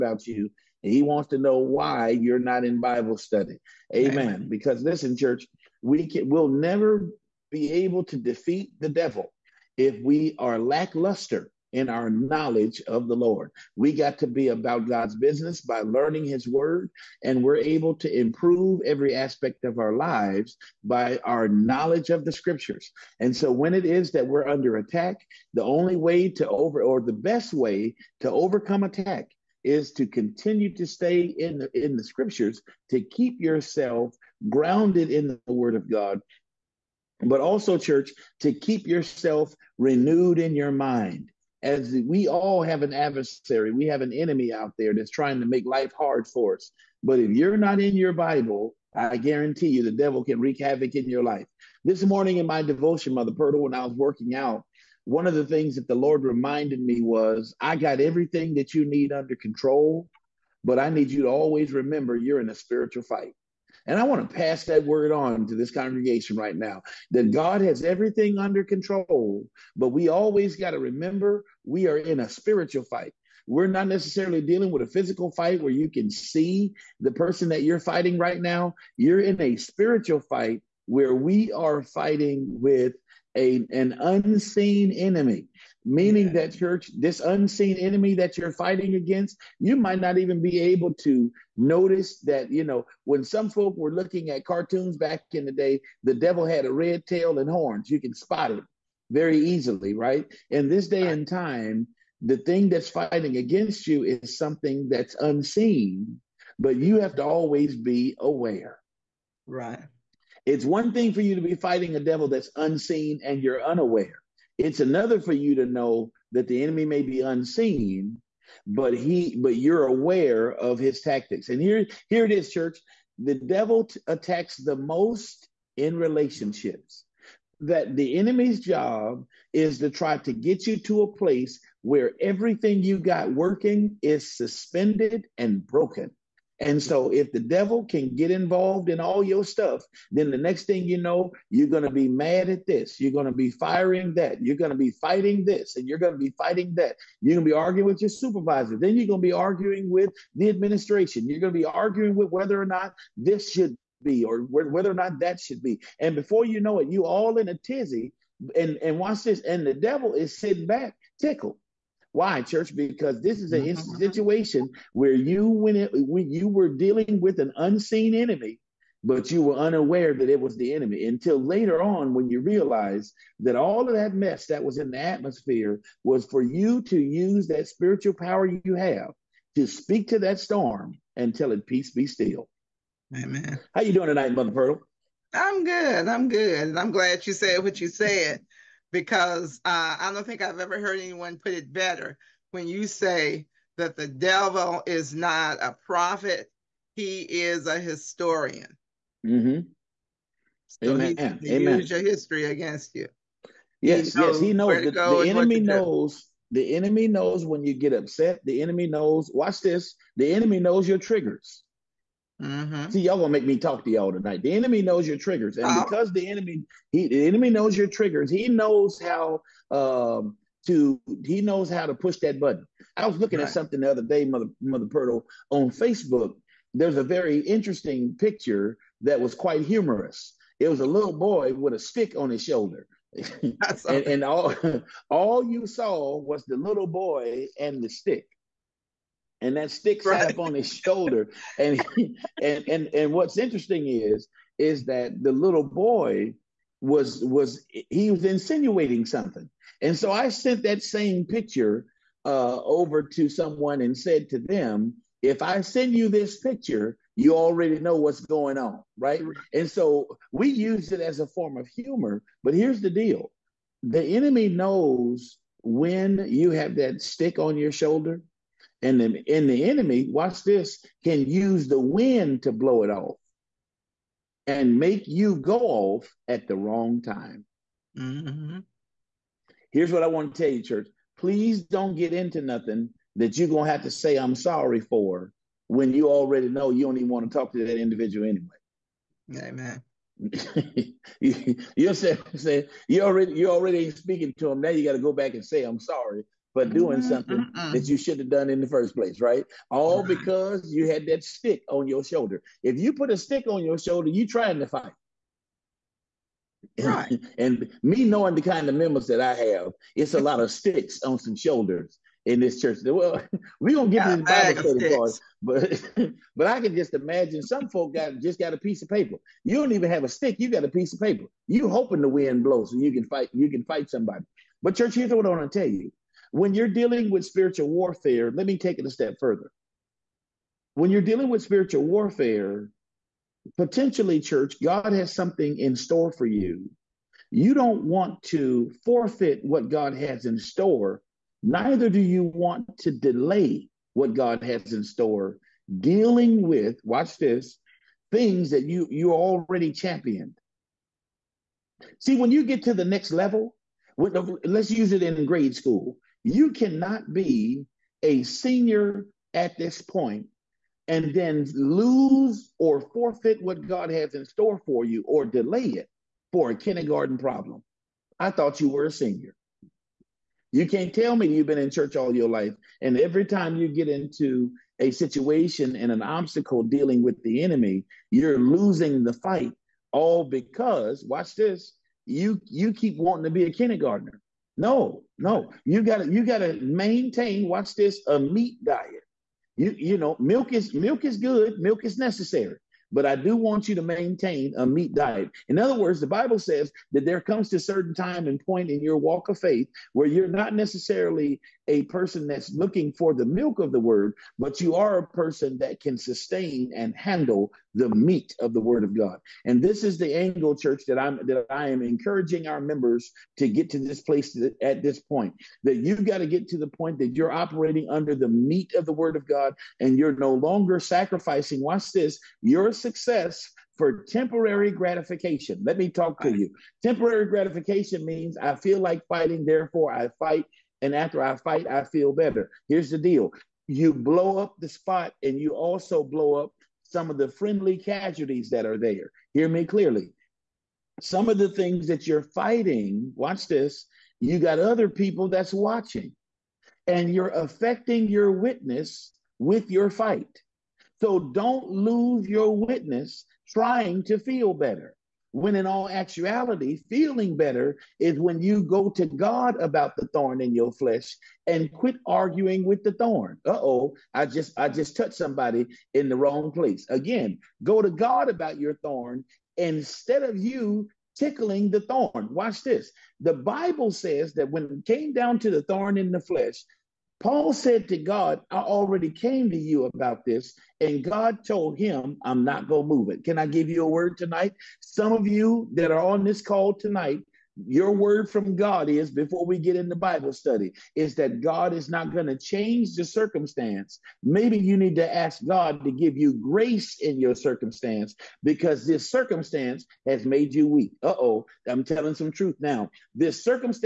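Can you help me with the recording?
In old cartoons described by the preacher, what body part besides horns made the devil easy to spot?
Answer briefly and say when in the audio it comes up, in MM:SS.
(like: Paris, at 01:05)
A red tail, at 01:36.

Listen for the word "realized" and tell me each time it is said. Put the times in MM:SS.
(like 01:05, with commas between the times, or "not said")
02:52.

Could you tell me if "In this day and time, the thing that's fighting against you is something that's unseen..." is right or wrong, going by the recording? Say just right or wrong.
right.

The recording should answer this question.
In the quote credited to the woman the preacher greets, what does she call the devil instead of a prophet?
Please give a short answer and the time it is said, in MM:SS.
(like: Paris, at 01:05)
A historian, at 03:17.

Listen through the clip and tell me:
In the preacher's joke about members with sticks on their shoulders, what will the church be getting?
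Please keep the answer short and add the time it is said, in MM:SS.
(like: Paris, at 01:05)
Bible study cards, at 05:14.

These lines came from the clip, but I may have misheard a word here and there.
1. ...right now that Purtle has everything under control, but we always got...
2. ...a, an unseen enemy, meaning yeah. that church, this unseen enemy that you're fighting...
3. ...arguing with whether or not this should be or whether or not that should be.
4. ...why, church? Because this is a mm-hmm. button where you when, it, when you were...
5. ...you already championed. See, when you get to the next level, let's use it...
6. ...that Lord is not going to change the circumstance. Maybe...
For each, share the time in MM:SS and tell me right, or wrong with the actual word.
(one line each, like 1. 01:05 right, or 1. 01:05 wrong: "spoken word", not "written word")
1. 01:06 wrong: "God", not "Purtle"
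2. 01:23 right
3. 02:31 right
4. 02:42 wrong: "situation", not "button"
5. 05:48 right
6. 08:11 wrong: "God", not "Lord".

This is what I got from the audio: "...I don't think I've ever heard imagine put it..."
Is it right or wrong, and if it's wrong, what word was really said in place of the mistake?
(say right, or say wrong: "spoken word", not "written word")
wrong: "anyone", not "imagine".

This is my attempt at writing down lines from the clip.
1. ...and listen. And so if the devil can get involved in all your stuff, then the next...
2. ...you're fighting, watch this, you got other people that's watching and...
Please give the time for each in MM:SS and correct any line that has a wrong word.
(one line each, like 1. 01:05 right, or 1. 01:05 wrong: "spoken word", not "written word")
1. 02:15 wrong: "broken", not "listen"
2. 07:22 right.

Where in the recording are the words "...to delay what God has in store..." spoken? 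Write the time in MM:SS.
05:42.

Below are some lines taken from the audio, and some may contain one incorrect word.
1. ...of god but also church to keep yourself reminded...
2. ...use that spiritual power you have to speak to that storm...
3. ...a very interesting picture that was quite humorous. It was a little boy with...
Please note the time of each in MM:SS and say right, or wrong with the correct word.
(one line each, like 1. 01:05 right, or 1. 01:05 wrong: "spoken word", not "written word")
1. 00:35 wrong: "renewed", not "reminded"
2. 02:56 right
3. 03:46 right.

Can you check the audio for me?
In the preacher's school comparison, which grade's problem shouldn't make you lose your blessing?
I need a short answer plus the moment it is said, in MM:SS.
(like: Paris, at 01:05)
Kindergarten, at 06:06.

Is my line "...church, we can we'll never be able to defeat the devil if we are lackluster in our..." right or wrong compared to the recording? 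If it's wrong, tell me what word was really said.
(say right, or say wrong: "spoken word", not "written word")
right.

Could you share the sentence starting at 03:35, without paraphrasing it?
because the enemy, he, the enemy knows your triggers.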